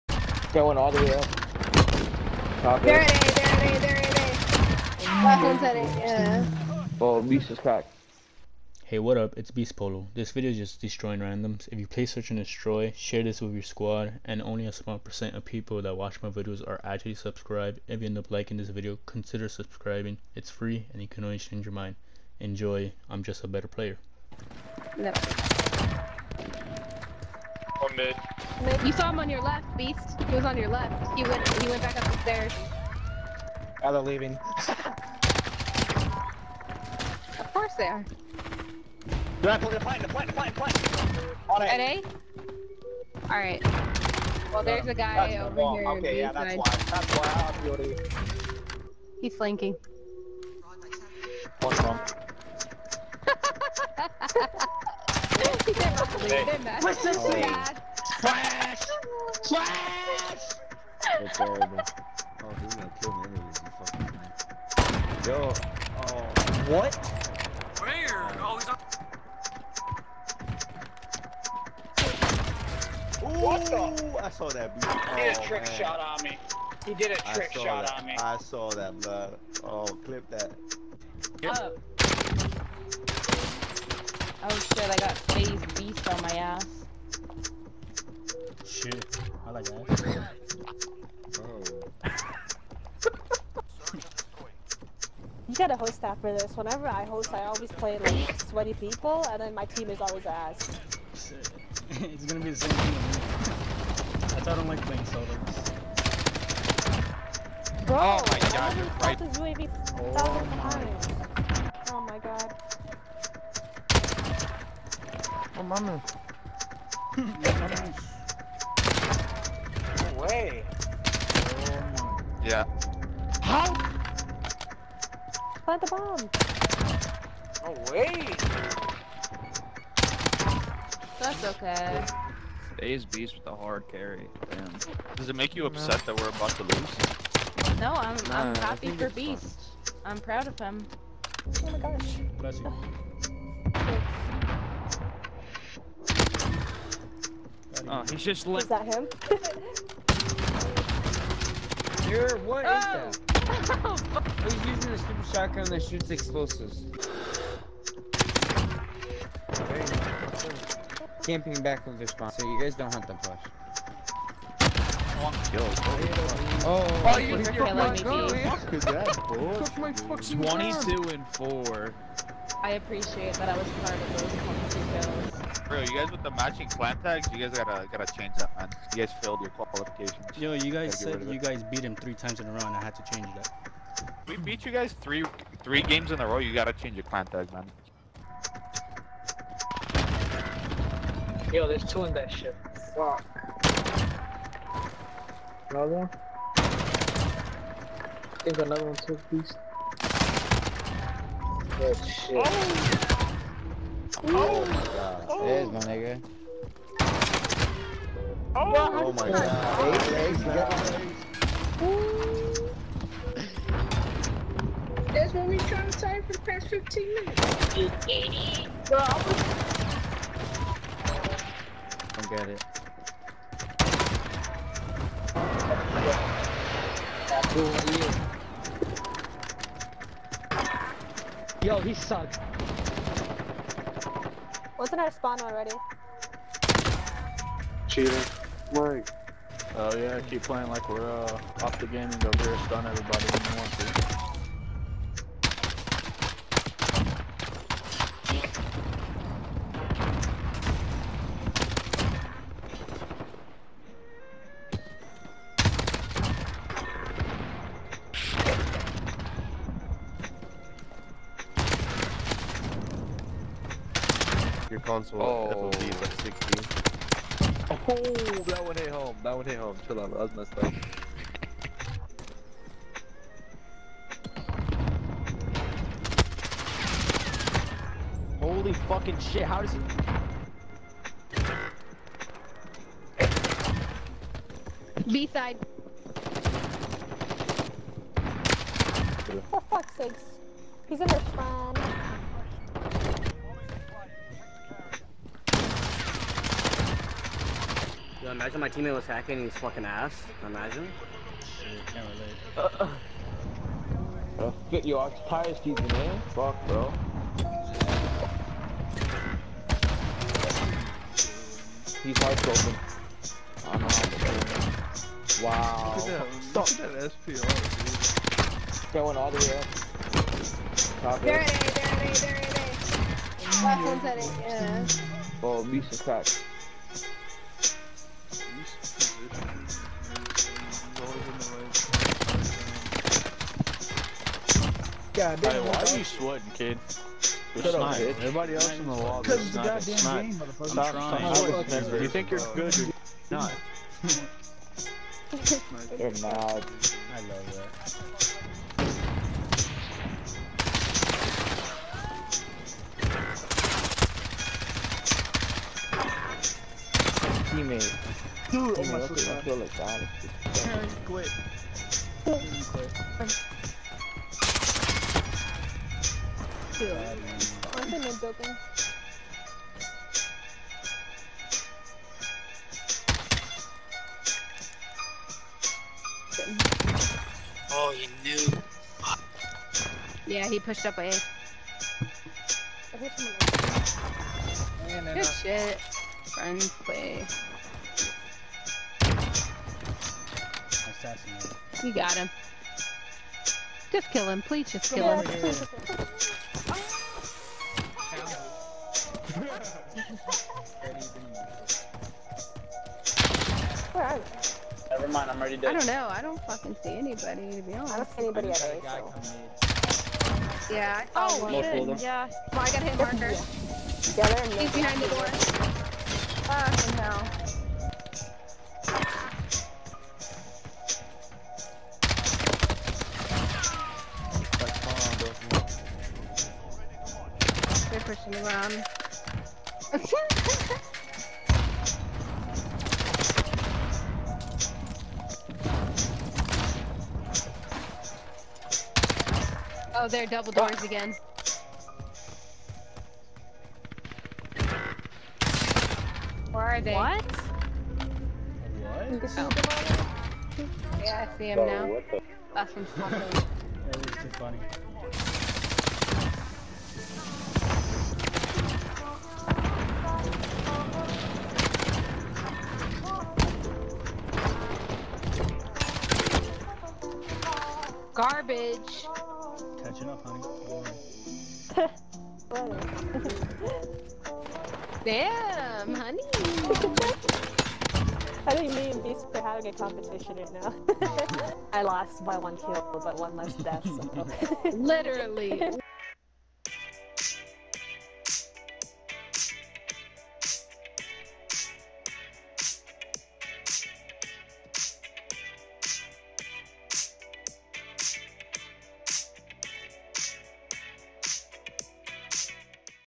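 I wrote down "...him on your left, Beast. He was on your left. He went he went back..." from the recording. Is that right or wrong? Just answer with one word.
right.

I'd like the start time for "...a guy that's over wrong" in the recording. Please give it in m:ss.
0:44.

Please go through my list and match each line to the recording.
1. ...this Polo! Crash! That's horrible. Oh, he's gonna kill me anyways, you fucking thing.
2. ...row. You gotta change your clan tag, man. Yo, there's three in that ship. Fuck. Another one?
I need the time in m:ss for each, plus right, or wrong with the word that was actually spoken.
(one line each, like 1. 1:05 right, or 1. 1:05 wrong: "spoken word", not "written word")
1. 0:57 wrong: "Crash", not "Polo"
2. 3:06 wrong: "two", not "three".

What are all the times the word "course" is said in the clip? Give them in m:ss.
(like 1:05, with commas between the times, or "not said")
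0:37.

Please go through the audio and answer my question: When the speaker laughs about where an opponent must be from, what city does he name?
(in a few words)
Stockholm.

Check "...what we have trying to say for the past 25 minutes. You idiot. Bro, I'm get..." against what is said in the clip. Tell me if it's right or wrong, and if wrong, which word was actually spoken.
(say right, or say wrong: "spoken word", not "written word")
wrong: "15", not "25".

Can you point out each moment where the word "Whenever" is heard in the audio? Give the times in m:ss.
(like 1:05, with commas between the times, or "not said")
1:36.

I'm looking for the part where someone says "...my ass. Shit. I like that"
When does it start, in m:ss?
1:26.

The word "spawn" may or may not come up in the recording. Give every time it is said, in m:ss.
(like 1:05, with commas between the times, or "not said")
2:42, 3:55.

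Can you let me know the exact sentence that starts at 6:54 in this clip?
Yeah, yeah He's behind the door.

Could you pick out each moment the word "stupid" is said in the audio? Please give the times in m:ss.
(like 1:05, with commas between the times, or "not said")
2:34.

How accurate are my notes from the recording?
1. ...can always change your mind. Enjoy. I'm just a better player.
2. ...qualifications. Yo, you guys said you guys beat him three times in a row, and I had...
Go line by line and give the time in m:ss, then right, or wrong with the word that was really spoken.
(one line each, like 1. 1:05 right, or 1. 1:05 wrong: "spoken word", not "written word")
1. 0:21 right
2. 2:59 right.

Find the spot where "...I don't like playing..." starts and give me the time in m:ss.
1:44.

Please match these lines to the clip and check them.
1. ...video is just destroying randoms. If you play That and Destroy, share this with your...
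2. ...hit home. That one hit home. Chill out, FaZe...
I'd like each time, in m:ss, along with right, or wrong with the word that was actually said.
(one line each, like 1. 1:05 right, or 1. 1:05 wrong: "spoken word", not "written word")
1. 0:10 wrong: "Search", not "That"
2. 4:28 wrong: "That", not "FaZe".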